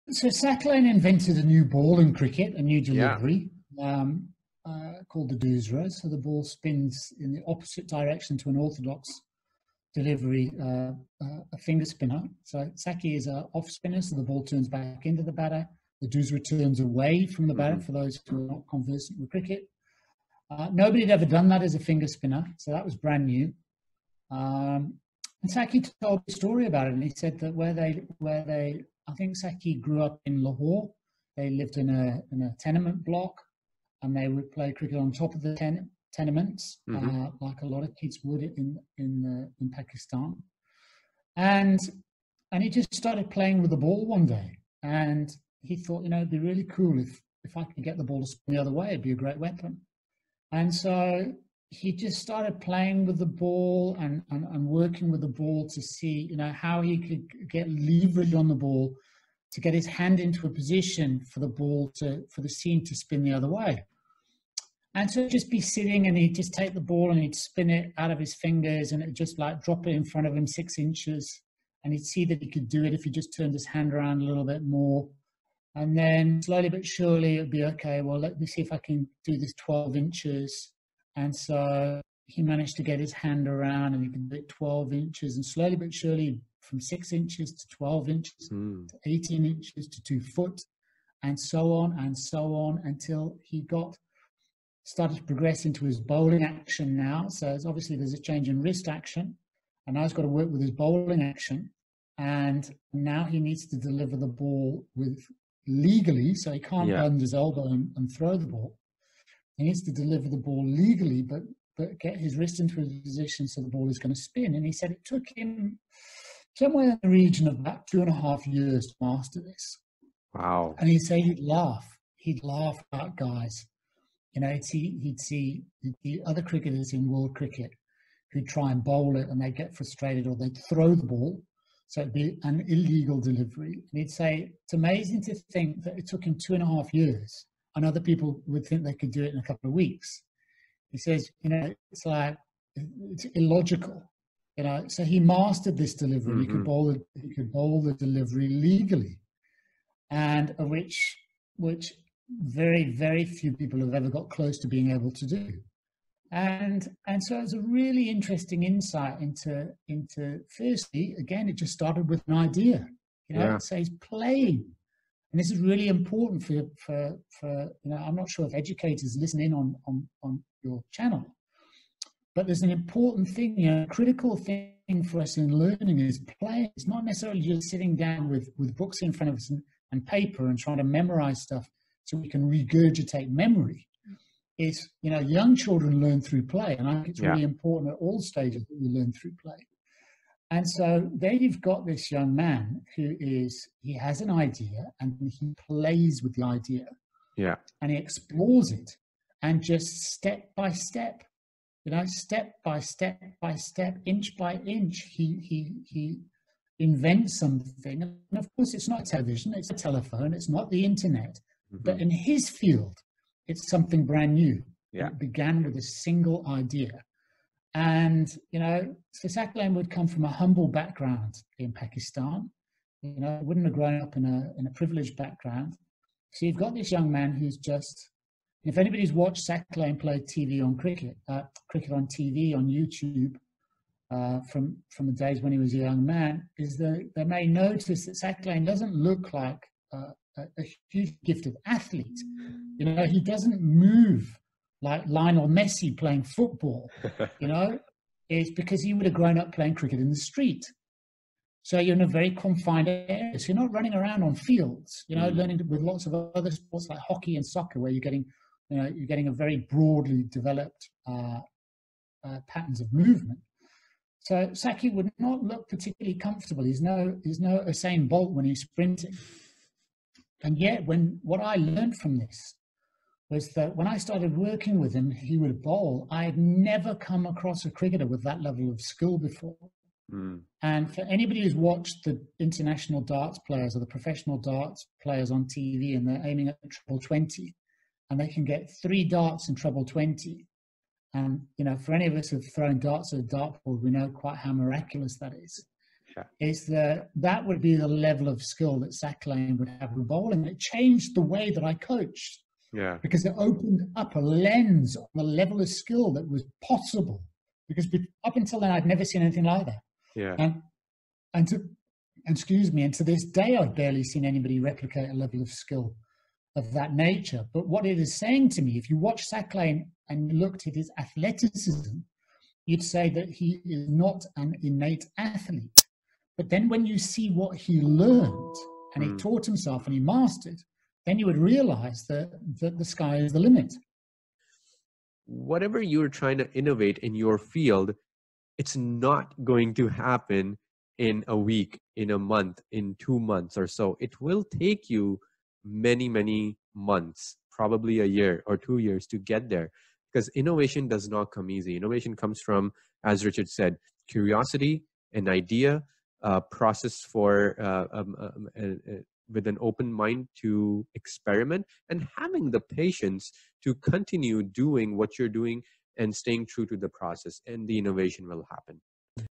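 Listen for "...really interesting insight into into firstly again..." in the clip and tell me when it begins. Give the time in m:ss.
2:37.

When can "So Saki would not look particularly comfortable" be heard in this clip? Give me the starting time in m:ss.
4:24.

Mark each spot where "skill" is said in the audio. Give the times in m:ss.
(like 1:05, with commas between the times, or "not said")
4:38, 4:58, 5:05, 5:15.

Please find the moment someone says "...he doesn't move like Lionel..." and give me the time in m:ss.
4:03.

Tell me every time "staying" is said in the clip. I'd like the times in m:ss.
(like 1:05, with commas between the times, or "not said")
6:06.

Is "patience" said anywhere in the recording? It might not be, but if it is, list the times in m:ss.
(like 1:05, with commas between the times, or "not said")
6:02.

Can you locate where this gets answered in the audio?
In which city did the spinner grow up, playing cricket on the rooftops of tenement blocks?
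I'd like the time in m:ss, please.
0:30.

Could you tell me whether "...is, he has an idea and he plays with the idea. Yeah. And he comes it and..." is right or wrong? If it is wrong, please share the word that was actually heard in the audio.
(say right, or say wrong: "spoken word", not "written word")
wrong: "explores", not "comes".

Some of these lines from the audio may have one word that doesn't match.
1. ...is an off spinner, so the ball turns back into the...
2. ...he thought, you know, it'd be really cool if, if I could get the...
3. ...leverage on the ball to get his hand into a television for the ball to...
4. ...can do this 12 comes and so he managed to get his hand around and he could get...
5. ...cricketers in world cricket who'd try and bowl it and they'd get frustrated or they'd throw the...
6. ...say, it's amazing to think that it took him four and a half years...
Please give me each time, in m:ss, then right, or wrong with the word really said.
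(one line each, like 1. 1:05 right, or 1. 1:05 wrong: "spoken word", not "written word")
1. 0:13 right
2. 0:45 right
3. 0:57 wrong: "position", not "television"
4. 1:18 wrong: "inches", not "comes"
5. 2:06 right
6. 2:14 wrong: "two", not "four".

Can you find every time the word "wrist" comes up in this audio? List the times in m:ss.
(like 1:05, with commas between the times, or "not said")
1:38, 1:52.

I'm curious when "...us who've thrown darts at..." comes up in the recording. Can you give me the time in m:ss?
4:52.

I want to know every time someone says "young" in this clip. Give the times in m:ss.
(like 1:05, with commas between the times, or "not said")
3:05, 3:12, 3:46, 3:55.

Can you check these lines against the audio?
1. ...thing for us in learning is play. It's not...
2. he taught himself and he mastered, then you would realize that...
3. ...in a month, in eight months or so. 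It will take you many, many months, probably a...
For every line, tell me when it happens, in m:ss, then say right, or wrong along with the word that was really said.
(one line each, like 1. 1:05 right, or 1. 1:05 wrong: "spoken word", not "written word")
1. 2:54 right
2. 5:29 right
3. 5:41 wrong: "two", not "eight".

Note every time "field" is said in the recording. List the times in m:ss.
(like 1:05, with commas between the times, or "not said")
3:32, 4:14, 5:37.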